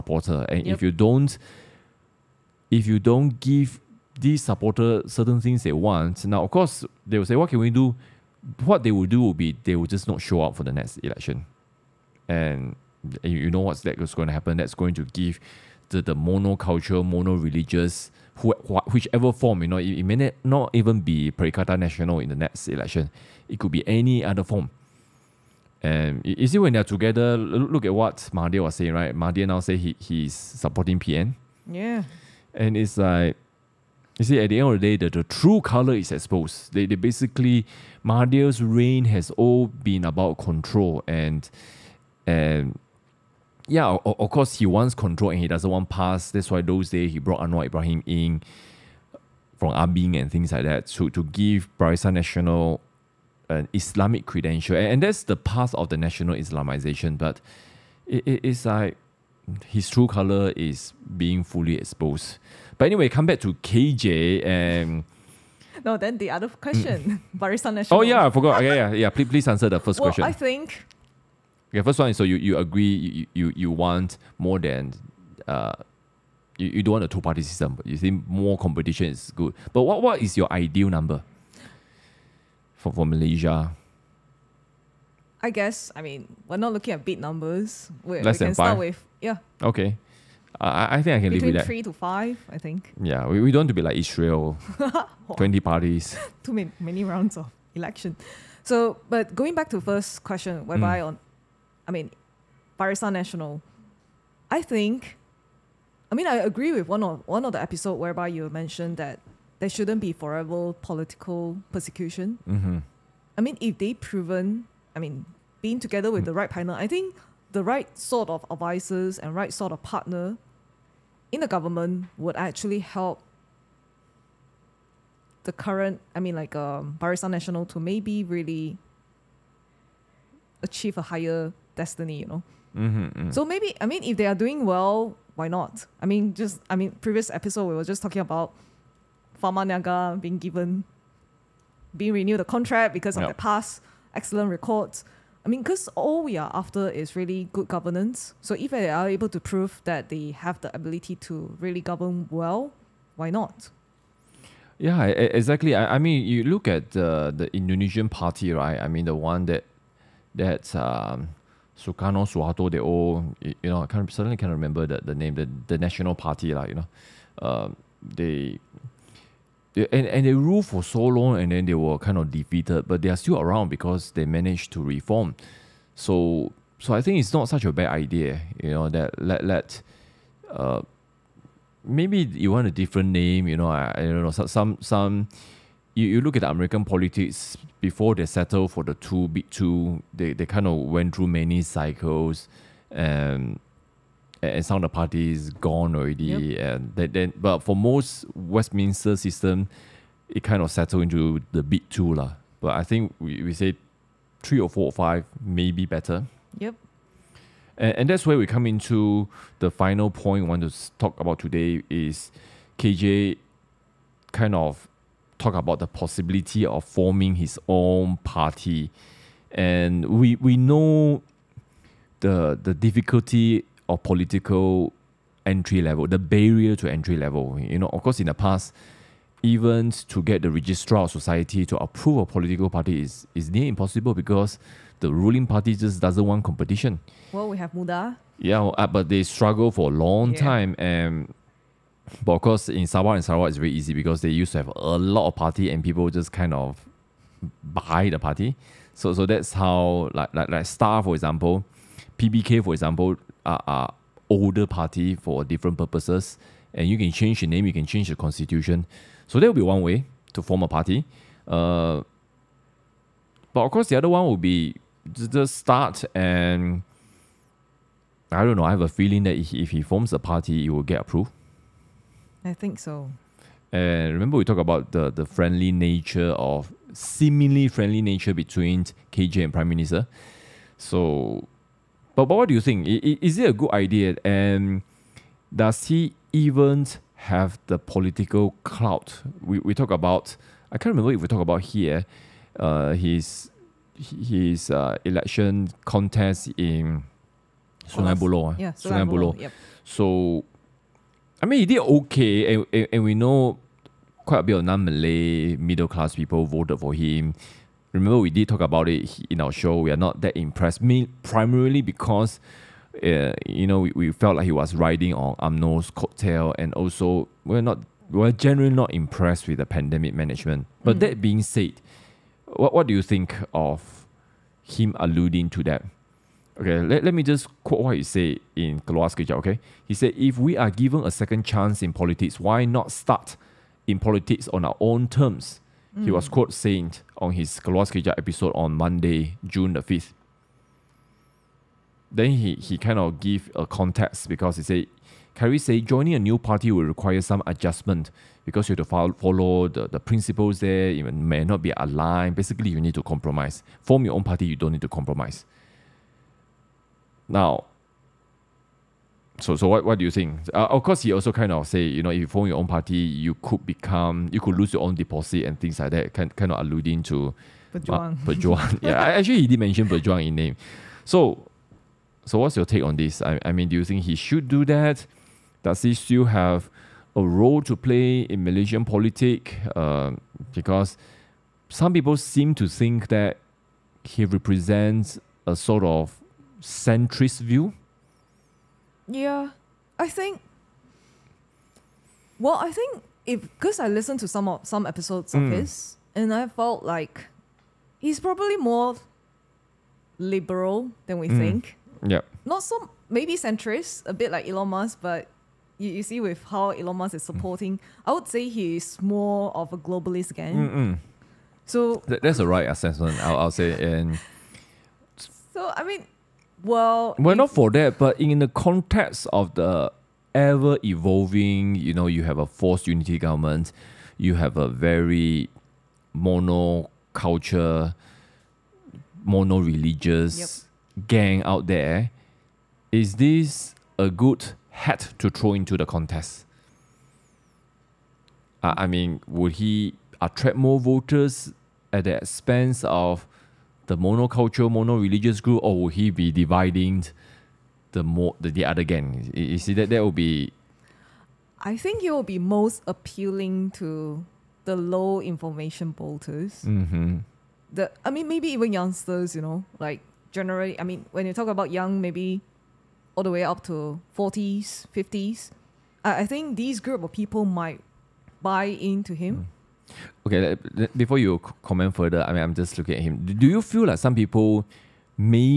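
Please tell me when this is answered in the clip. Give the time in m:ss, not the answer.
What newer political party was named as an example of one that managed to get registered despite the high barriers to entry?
3:57.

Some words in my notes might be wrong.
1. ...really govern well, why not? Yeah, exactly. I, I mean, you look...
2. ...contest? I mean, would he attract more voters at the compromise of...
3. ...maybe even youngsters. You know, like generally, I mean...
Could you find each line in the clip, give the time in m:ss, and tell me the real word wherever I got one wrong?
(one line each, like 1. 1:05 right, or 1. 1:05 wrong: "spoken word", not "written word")
1. 2:31 right
2. 7:15 wrong: "expense", not "compromise"
3. 7:38 right.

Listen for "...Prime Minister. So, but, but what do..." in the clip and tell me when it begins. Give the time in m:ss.
4:39.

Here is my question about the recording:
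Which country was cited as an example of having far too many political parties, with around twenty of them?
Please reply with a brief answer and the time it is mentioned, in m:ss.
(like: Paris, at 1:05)
Israel, at 1:33.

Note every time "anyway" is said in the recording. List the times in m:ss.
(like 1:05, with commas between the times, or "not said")
1:02.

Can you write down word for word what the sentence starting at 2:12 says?
Mm-hmm, mm So maybe I mean, if they are doing well, why not?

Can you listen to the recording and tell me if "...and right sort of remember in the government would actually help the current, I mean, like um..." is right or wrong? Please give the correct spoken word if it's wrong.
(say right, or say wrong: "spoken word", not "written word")
wrong: "partner", not "remember".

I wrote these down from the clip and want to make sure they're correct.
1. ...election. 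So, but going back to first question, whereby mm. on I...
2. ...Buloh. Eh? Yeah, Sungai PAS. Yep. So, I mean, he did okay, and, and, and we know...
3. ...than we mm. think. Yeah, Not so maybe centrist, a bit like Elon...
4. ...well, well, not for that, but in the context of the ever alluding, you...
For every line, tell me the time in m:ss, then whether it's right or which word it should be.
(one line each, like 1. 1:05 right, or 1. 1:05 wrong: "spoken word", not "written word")
1. 1:37 right
2. 4:58 wrong: "Buloh", not "PAS"
3. 6:41 right
4. 6:56 wrong: "evolving", not "alluding".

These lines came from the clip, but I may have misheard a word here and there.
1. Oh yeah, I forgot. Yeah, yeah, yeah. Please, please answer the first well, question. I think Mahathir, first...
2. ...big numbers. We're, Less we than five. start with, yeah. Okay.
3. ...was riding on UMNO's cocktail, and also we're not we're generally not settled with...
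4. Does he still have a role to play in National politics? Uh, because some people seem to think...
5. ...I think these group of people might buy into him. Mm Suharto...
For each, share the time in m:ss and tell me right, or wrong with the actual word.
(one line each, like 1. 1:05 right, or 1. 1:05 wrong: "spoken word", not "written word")
1. 1:07 wrong: "Okay", not "Mahathir"
2. 1:27 right
3. 5:14 wrong: "impressed", not "settled"
4. 6:15 wrong: "Malaysian", not "National"
5. 7:46 wrong: "Okay", not "Suharto".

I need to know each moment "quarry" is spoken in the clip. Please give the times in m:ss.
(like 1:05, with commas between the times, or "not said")
not said.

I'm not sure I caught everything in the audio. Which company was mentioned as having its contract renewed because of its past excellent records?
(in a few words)
Pharmaniaga.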